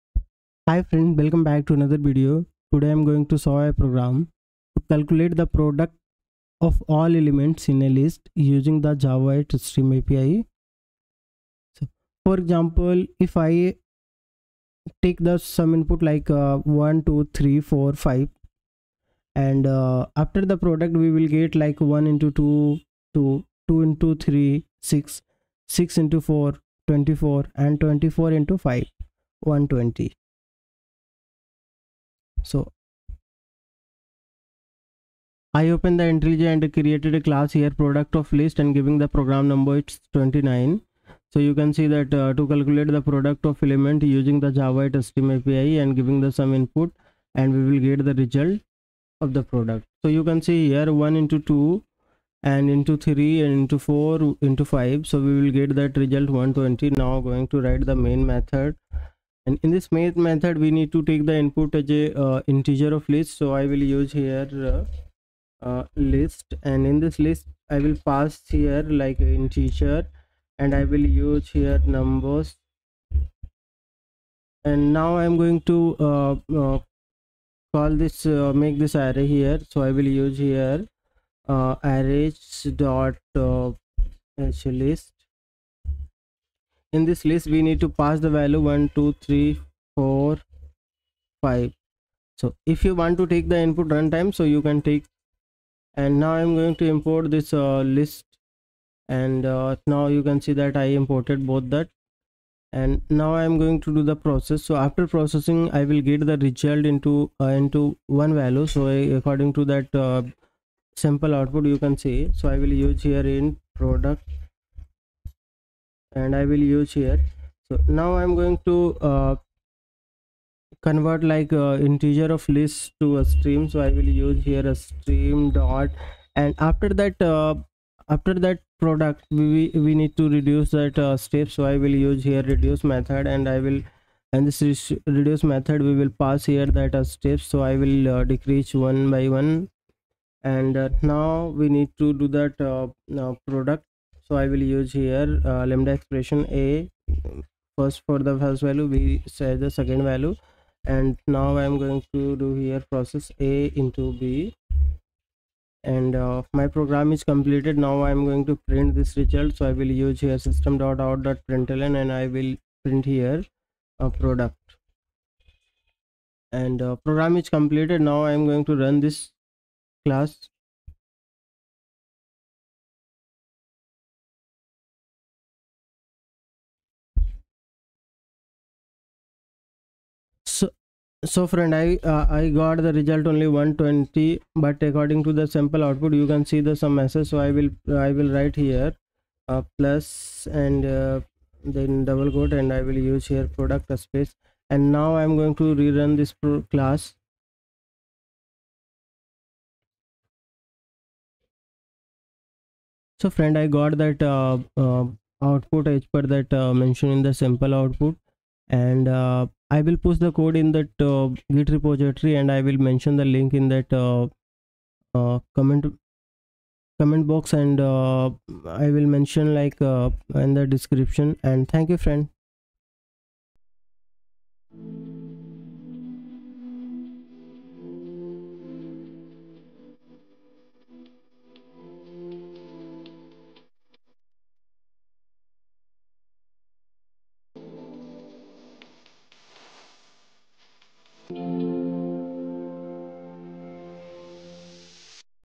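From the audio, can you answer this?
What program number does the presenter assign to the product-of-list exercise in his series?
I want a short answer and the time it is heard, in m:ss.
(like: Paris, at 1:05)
29, at 0:39.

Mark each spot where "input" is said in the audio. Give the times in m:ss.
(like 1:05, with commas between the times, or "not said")
0:15, 0:46, 1:01, 1:33.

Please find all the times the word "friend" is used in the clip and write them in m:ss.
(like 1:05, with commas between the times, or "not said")
0:00, 3:01, 3:23, 3:42.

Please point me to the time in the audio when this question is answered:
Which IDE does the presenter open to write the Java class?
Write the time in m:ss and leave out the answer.
0:36.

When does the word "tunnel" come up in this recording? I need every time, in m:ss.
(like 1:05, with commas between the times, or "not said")
not said.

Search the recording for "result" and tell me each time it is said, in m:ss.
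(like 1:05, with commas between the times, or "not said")
0:48, 0:55, 1:46, 2:39, 3:02.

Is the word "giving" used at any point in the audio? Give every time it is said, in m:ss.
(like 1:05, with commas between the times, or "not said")
0:38, 0:45.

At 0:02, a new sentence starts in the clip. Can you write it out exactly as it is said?
Today I'm going to solve a program to calculate the product of all elements in a list using the Java Stream API.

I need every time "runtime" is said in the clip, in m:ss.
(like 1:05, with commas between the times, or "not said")
1:33.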